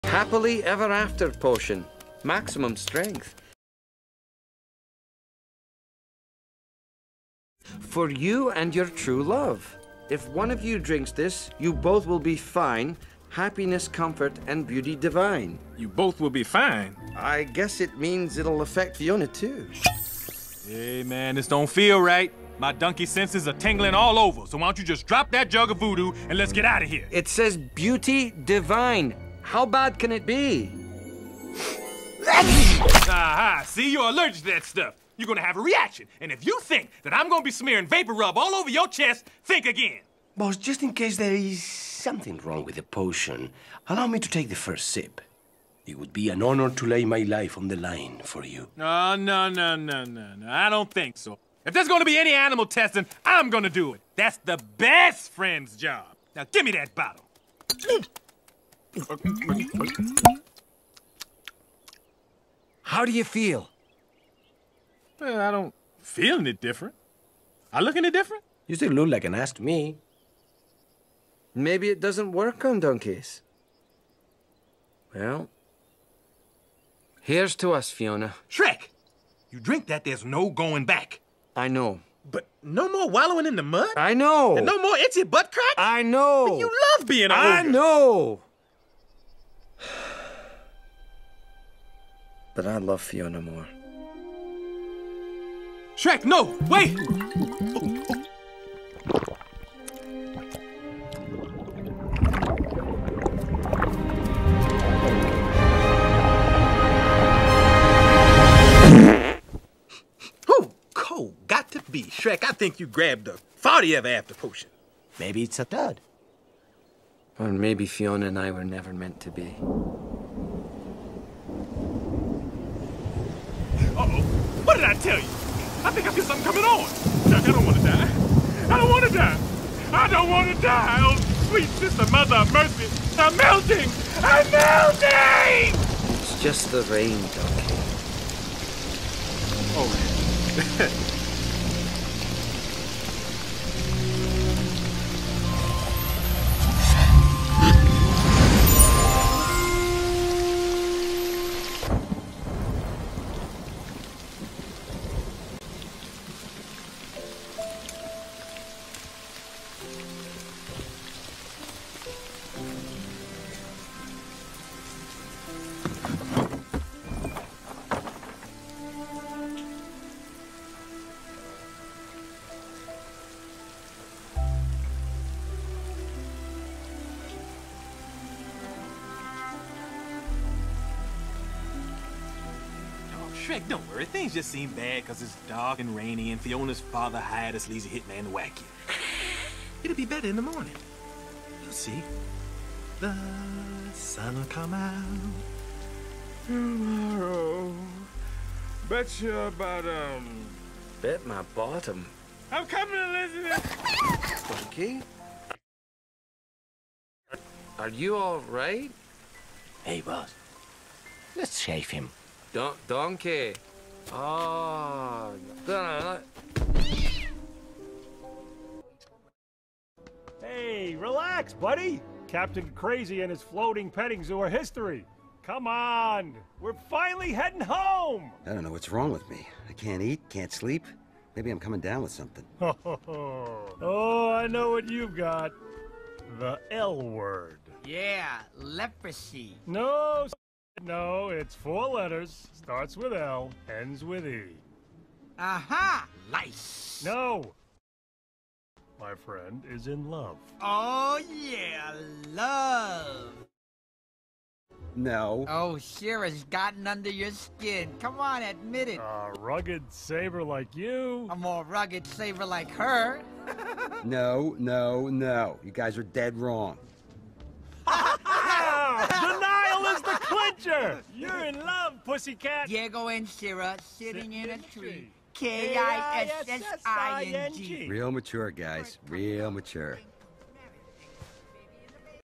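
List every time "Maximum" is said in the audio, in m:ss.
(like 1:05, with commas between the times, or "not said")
0:02.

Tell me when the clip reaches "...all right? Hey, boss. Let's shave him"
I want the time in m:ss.
3:28.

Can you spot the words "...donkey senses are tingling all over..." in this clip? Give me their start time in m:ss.
0:22.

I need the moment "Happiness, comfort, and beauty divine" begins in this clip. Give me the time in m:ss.
0:13.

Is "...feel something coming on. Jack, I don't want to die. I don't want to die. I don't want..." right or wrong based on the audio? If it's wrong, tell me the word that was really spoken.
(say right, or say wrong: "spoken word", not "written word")
right.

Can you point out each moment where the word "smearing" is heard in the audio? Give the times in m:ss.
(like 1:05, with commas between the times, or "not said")
0:37.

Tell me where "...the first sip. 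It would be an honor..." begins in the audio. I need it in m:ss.
0:44.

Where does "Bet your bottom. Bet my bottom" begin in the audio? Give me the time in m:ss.
3:18.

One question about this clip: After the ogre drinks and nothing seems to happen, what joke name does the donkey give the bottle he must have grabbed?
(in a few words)
Farty ever after potion.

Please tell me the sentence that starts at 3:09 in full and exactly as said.
It'll be better in the morning.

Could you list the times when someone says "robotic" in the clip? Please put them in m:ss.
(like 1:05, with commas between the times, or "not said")
not said.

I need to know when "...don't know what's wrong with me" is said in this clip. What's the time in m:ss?
3:48.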